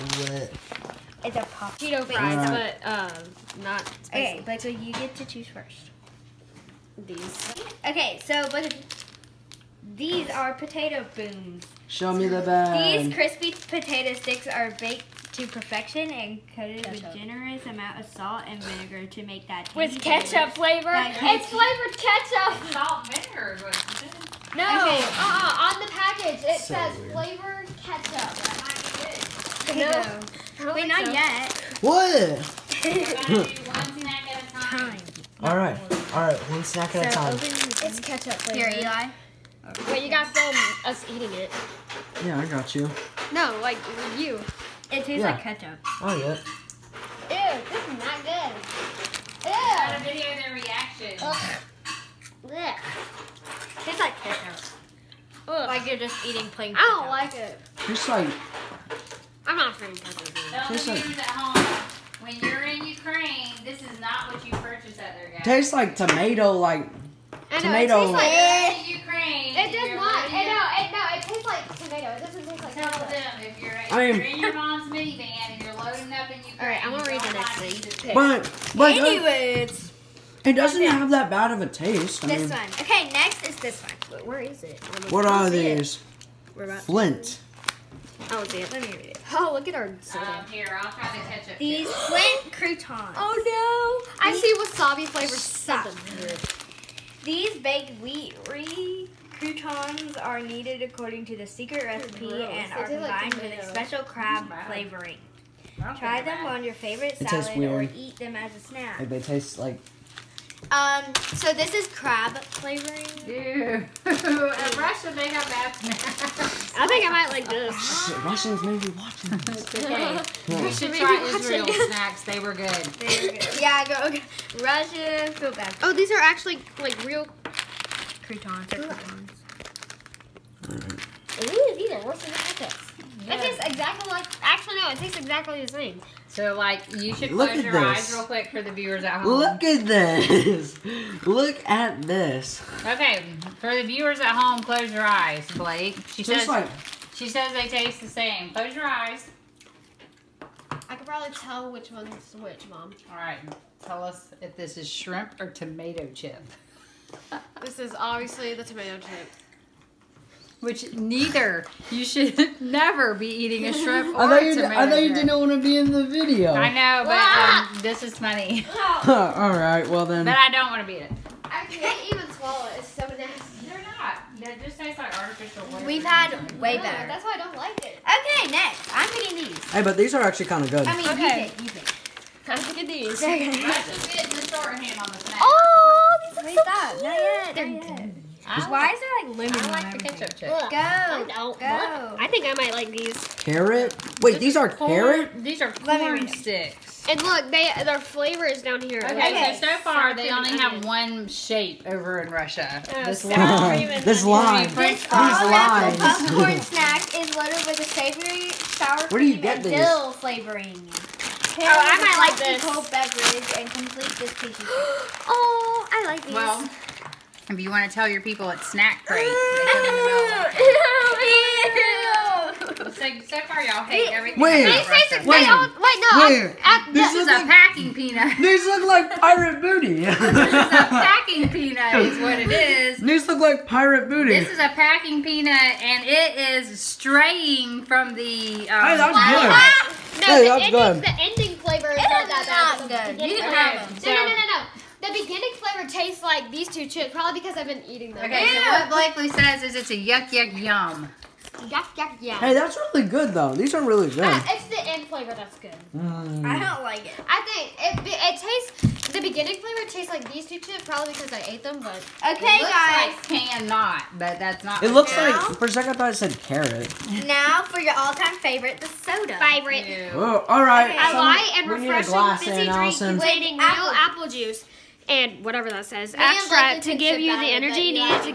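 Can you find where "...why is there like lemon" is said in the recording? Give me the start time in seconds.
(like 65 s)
188 s.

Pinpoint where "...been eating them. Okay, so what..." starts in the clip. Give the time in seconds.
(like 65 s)
247 s.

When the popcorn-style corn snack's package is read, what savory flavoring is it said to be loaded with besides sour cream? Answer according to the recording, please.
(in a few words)
dill.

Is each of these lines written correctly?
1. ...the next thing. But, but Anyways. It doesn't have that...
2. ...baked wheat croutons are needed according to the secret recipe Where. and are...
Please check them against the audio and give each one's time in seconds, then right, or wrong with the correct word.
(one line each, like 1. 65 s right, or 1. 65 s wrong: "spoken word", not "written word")
1. 77 s right
2. 97 s wrong: "Gross", not "Where".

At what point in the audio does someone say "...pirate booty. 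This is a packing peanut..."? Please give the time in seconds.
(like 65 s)
233 s.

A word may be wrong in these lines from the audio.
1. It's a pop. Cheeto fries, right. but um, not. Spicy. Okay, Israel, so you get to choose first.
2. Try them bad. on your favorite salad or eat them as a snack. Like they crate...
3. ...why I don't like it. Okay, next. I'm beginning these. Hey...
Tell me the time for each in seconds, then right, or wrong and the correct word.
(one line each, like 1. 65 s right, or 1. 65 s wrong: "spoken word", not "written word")
1. 1 s wrong: "Blake", not "Israel"
2. 105 s wrong: "taste", not "crate"
3. 177 s wrong: "eating", not "beginning".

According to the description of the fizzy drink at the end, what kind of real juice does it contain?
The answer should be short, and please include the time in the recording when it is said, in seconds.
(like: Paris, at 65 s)
apple juice, at 273 s.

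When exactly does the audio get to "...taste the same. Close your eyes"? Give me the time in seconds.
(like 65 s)
147 s.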